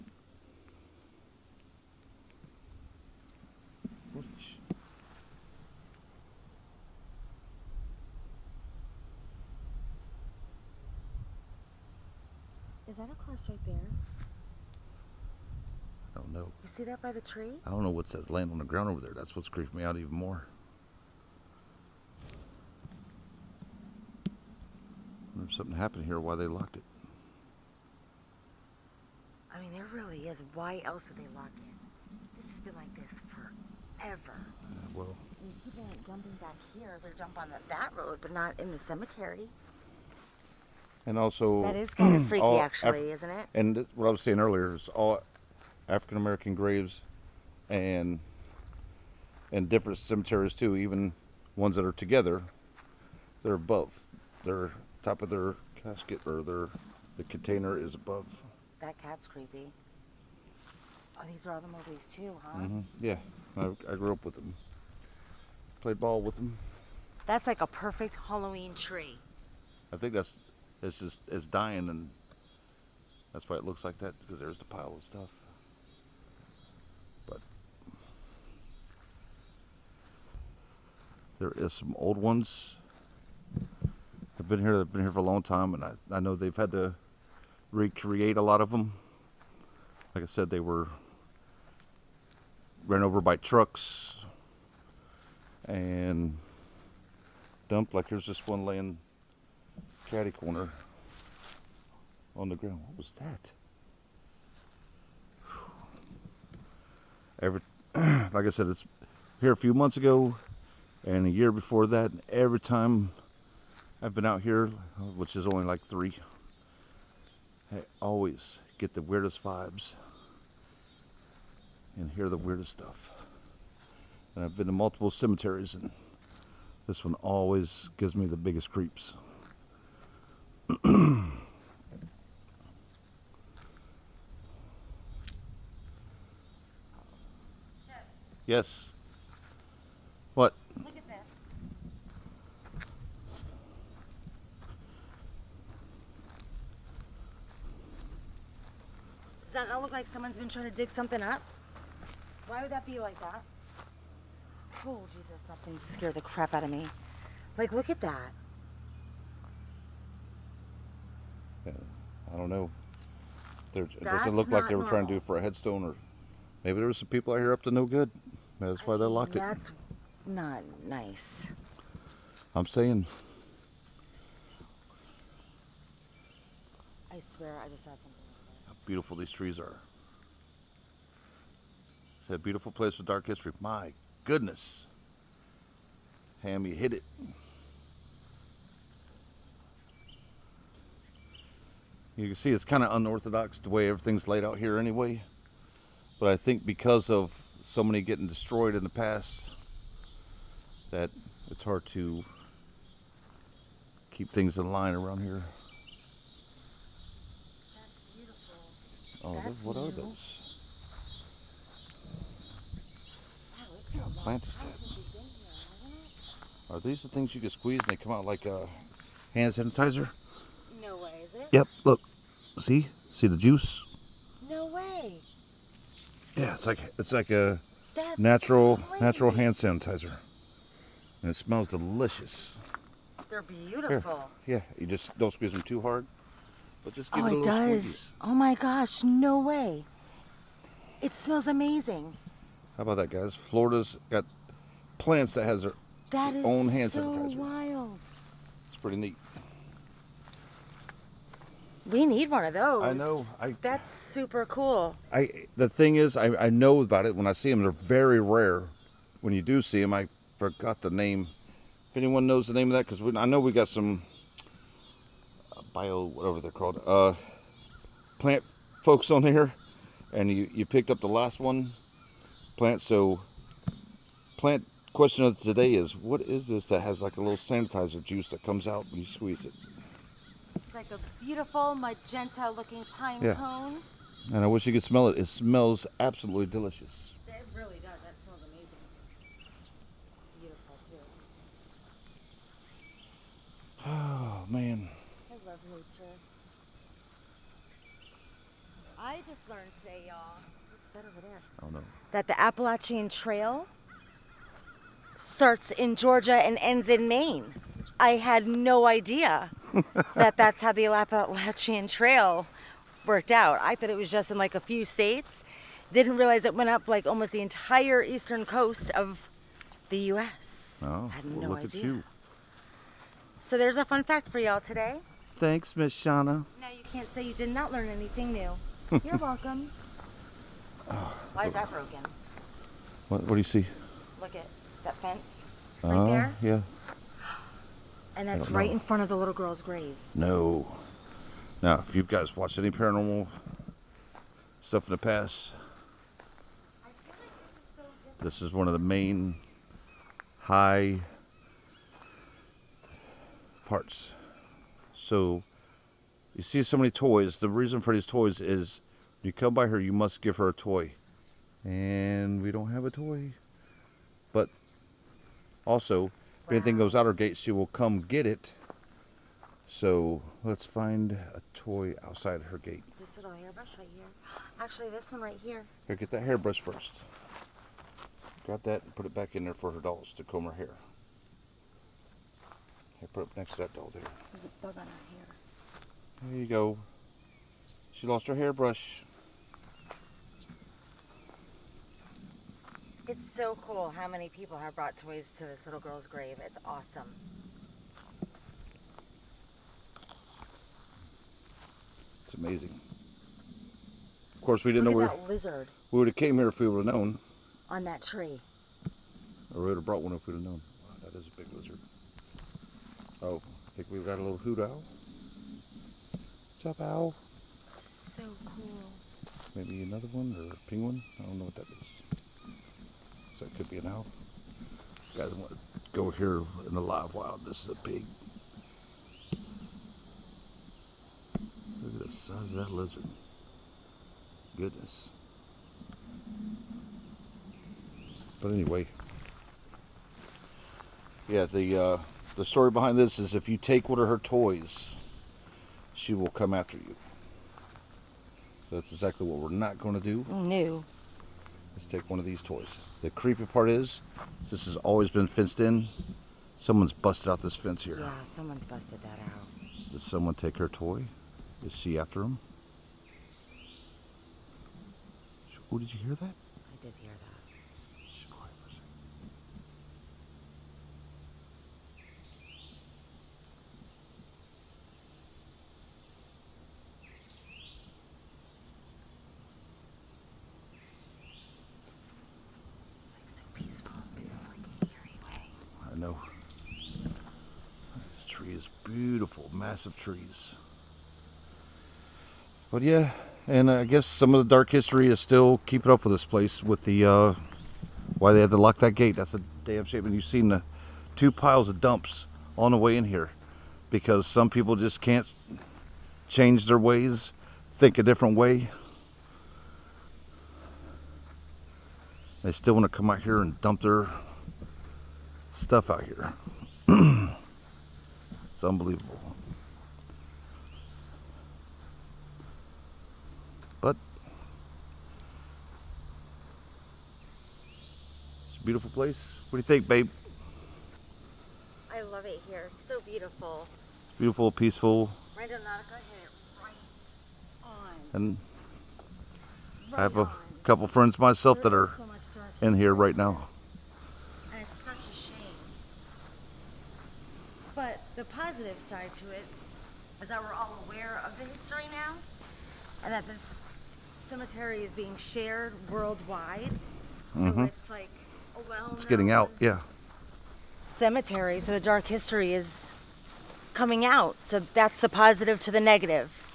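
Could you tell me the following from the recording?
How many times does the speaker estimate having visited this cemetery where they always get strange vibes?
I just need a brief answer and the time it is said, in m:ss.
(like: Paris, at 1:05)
3, at 1:55.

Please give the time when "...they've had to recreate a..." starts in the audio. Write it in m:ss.
1:26.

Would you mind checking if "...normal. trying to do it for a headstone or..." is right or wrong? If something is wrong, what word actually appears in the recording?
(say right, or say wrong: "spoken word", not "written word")
right.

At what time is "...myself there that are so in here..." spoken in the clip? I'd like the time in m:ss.
9:01.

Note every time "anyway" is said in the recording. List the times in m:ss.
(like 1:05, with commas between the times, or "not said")
3:14, 7:18.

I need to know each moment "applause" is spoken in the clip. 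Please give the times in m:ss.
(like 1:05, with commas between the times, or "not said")
not said.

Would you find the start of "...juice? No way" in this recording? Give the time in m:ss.
3:43.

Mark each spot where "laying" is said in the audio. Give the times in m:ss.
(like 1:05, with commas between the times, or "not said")
0:18, 1:38.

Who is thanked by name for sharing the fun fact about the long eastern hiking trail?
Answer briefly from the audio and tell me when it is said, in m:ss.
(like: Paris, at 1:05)
Miss Shauna, at 5:25.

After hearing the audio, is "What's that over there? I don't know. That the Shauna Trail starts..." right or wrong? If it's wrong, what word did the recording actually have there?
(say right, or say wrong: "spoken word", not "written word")
wrong: "Appalachian", not "Shauna".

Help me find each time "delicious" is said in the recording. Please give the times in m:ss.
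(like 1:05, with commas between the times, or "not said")
3:51, 4:46.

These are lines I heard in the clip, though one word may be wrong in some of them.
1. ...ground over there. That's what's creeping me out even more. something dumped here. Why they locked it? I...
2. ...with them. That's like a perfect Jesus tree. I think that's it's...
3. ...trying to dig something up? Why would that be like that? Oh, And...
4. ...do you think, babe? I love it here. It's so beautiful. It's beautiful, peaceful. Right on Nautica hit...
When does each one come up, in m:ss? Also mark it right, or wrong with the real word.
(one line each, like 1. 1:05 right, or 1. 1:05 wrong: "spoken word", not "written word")
1. 0:18 wrong: "happened", not "dumped"
2. 1:06 wrong: "Halloween", not "Jesus"
3. 2:30 wrong: "Jesus", not "And"
4. 8:49 right.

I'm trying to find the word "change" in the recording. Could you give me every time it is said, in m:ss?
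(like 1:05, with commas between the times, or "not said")
8:26.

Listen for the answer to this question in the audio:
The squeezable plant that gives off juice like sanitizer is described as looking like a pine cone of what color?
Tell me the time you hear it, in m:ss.
4:41.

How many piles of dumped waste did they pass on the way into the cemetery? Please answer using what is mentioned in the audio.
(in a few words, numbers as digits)
2.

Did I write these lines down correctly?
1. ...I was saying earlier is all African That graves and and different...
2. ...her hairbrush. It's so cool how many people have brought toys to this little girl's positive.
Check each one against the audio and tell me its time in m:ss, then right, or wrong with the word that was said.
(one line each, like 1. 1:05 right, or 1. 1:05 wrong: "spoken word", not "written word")
1. 0:44 wrong: "American", not "That"
2. 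6:28 wrong: "grave", not "positive".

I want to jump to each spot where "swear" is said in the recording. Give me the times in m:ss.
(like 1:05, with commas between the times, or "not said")
2:57.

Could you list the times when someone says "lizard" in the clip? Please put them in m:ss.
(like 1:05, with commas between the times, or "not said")
6:45, 6:51, 7:12.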